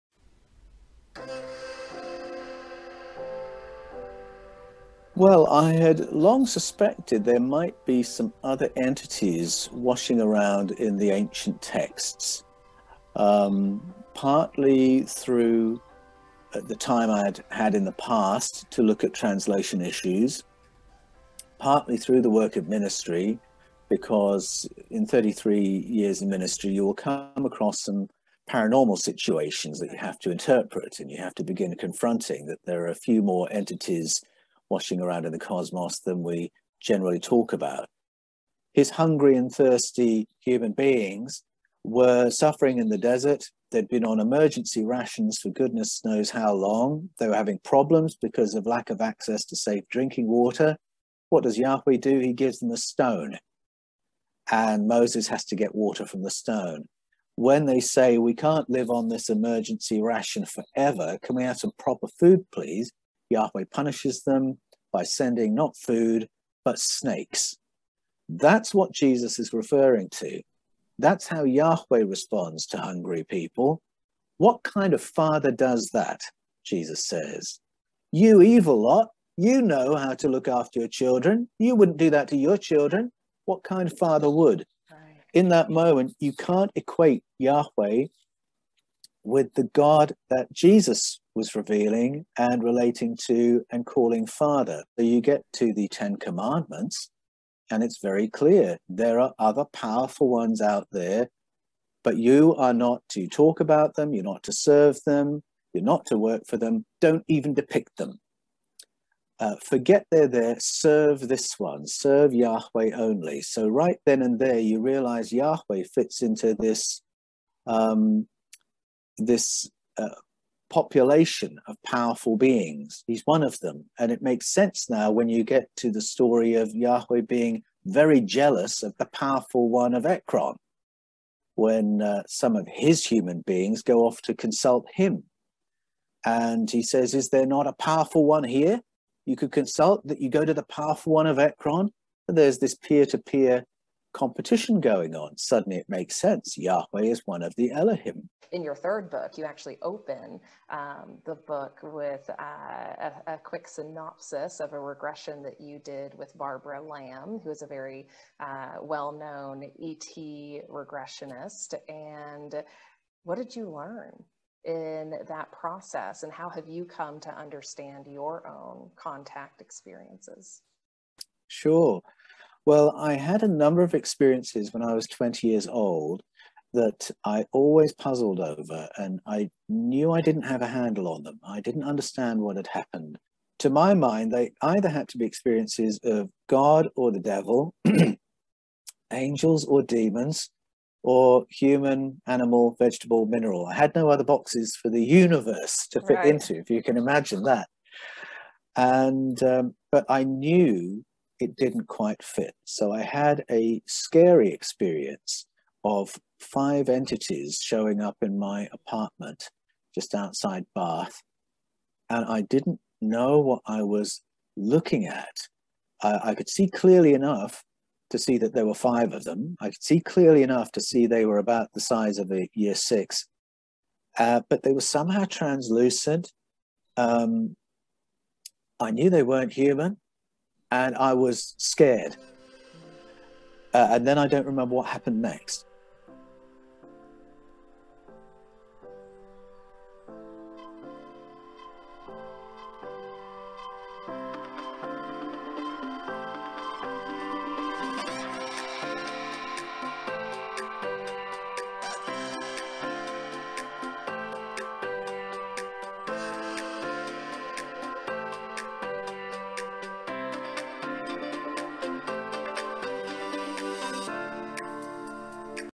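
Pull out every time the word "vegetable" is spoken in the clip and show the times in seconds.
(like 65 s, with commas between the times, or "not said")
192 s.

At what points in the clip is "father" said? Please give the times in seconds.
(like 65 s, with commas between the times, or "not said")
75 s, 83 s, 94 s.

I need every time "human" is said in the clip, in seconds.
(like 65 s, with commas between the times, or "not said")
40 s, 133 s, 191 s, 229 s.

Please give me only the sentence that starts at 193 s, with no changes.
I had no other boxes for the universe to fit right.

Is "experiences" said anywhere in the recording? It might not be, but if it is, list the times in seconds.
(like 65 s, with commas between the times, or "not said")
169 s, 173 s, 185 s, 204 s.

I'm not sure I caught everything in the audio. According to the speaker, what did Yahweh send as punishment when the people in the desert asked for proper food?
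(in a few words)
Snakes.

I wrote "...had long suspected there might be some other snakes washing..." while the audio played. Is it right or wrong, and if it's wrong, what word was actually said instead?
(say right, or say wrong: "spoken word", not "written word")
wrong: "entities", not "snakes".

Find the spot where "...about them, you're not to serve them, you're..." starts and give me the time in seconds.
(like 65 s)
103 s.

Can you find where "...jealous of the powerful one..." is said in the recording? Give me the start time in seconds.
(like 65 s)
128 s.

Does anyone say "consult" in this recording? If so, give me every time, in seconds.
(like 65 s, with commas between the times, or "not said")
134 s, 139 s.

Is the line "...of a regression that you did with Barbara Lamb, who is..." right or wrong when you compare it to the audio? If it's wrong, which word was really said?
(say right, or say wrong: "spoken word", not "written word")
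right.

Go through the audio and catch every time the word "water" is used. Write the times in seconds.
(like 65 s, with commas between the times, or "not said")
50 s, 55 s.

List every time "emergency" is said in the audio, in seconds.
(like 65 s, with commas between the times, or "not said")
44 s, 59 s.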